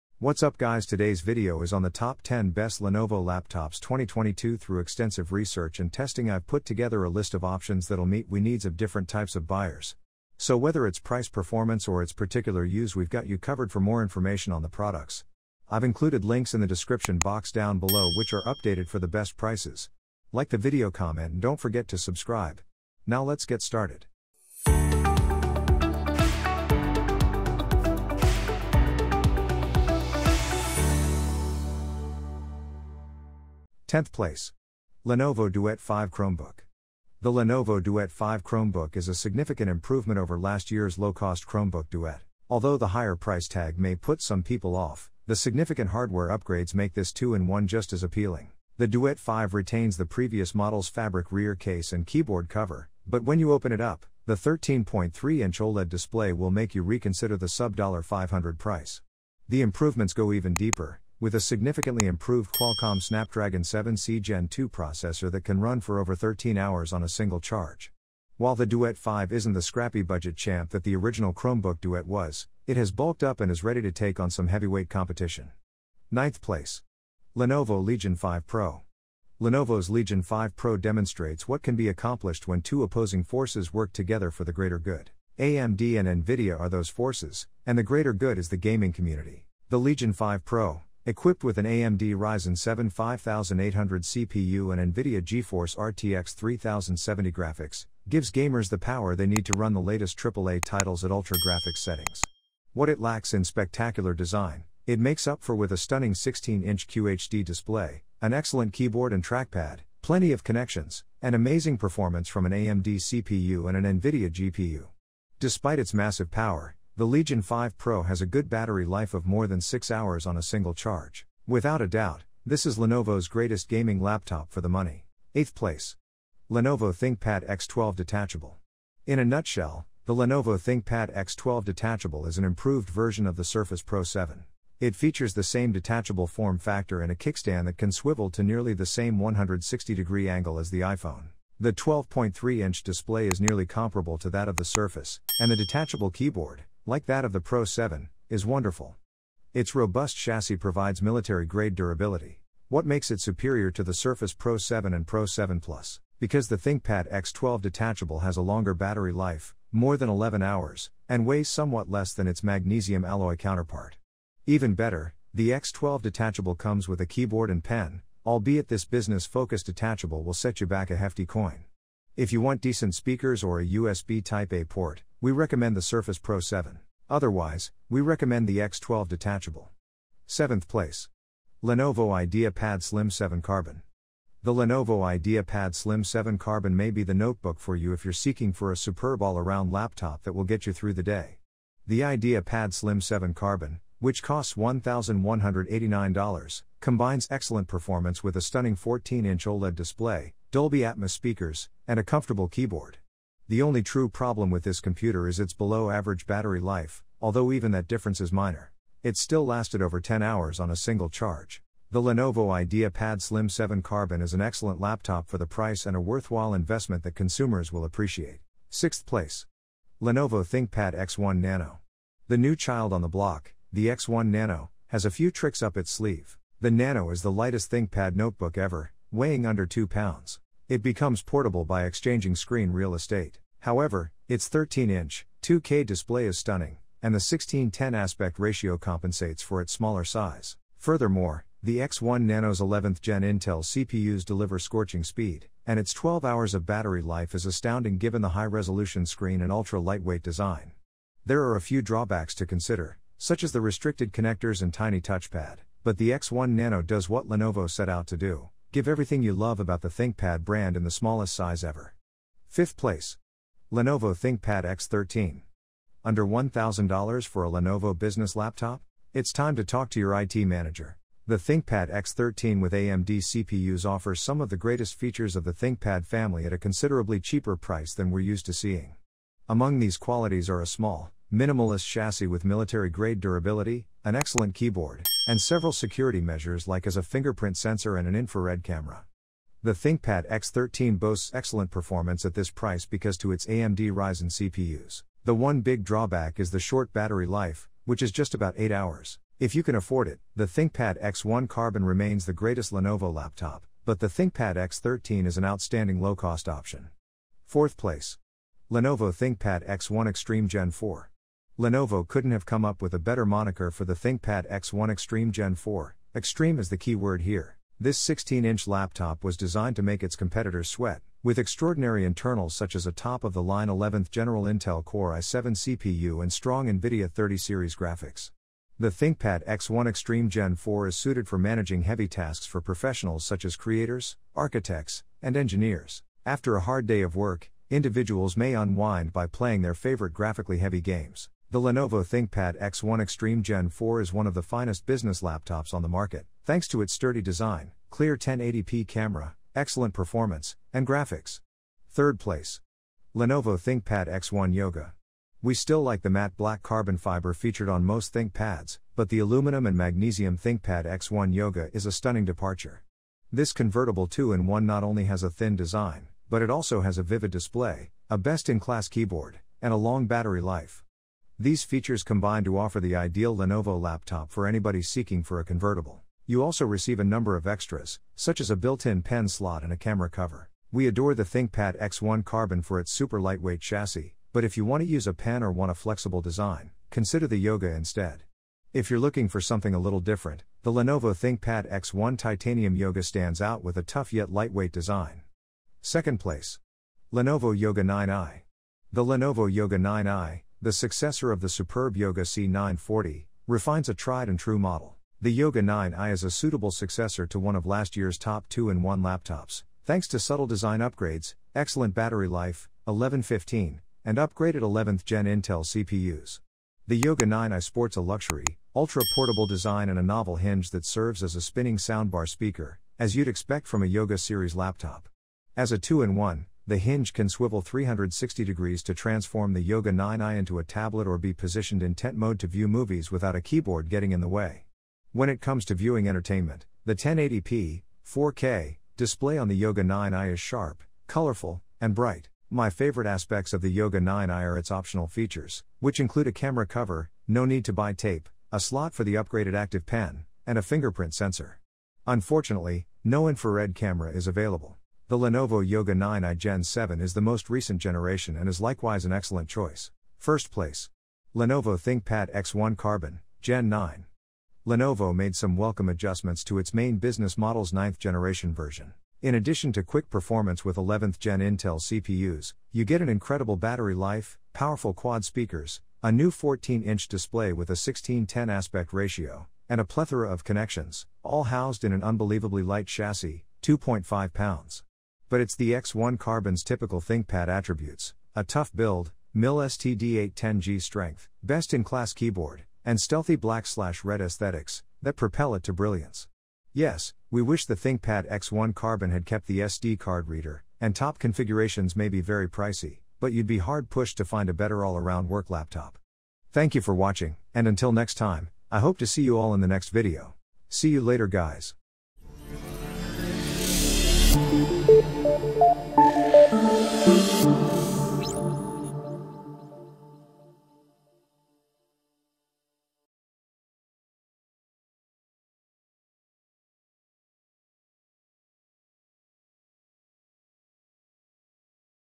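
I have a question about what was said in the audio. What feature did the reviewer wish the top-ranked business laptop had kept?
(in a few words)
SD card reader.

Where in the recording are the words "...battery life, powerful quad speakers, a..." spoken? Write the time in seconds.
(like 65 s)
473 s.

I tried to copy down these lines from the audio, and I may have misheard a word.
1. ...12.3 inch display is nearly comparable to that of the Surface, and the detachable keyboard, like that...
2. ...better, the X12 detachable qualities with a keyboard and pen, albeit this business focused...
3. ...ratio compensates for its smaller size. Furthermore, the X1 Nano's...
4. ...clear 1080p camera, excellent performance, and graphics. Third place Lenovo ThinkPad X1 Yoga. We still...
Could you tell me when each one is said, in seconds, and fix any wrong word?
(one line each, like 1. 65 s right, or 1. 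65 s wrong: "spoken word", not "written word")
1. 141 s right
2. 164 s wrong: "comes", not "qualities"
3. 238 s right
4. 347 s right.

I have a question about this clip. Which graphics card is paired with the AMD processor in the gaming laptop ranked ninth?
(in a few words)
NVIDIA GeForce RTX 3070.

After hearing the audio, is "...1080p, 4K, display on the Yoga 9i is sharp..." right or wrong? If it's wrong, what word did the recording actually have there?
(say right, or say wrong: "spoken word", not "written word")
right.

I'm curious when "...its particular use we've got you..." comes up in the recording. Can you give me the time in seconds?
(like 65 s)
12 s.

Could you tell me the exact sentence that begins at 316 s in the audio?
Extreme is the key word here.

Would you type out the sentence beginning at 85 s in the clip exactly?
AMD and Nvidia are those forces, and the greater good is the gaming community.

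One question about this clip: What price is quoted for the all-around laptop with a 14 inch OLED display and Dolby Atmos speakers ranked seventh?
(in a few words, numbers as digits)
$1,189.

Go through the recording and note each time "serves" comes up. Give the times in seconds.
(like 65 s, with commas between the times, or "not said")
420 s.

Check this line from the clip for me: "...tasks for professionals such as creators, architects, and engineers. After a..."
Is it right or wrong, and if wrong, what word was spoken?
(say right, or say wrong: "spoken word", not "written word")
right.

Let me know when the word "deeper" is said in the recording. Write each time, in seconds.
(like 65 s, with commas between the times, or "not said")
60 s.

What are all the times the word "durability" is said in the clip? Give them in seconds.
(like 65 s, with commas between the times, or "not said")
151 s, 283 s.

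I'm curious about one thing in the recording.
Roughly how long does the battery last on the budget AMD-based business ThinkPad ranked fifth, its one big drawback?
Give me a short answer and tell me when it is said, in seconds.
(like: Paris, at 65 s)
8 hours, at 298 s.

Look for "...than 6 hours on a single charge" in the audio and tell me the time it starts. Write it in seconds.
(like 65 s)
119 s.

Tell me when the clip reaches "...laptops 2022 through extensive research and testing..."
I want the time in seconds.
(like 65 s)
3 s.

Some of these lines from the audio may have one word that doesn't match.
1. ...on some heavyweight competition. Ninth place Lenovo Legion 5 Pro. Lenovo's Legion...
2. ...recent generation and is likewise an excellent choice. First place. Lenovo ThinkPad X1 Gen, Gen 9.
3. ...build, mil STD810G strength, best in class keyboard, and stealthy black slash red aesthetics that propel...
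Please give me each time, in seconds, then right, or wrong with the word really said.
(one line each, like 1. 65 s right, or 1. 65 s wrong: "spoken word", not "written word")
1. 74 s right
2. 457 s wrong: "Carbon", not "Gen"
3. 488 s right.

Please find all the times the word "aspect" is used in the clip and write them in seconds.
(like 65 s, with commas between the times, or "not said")
237 s, 443 s, 478 s.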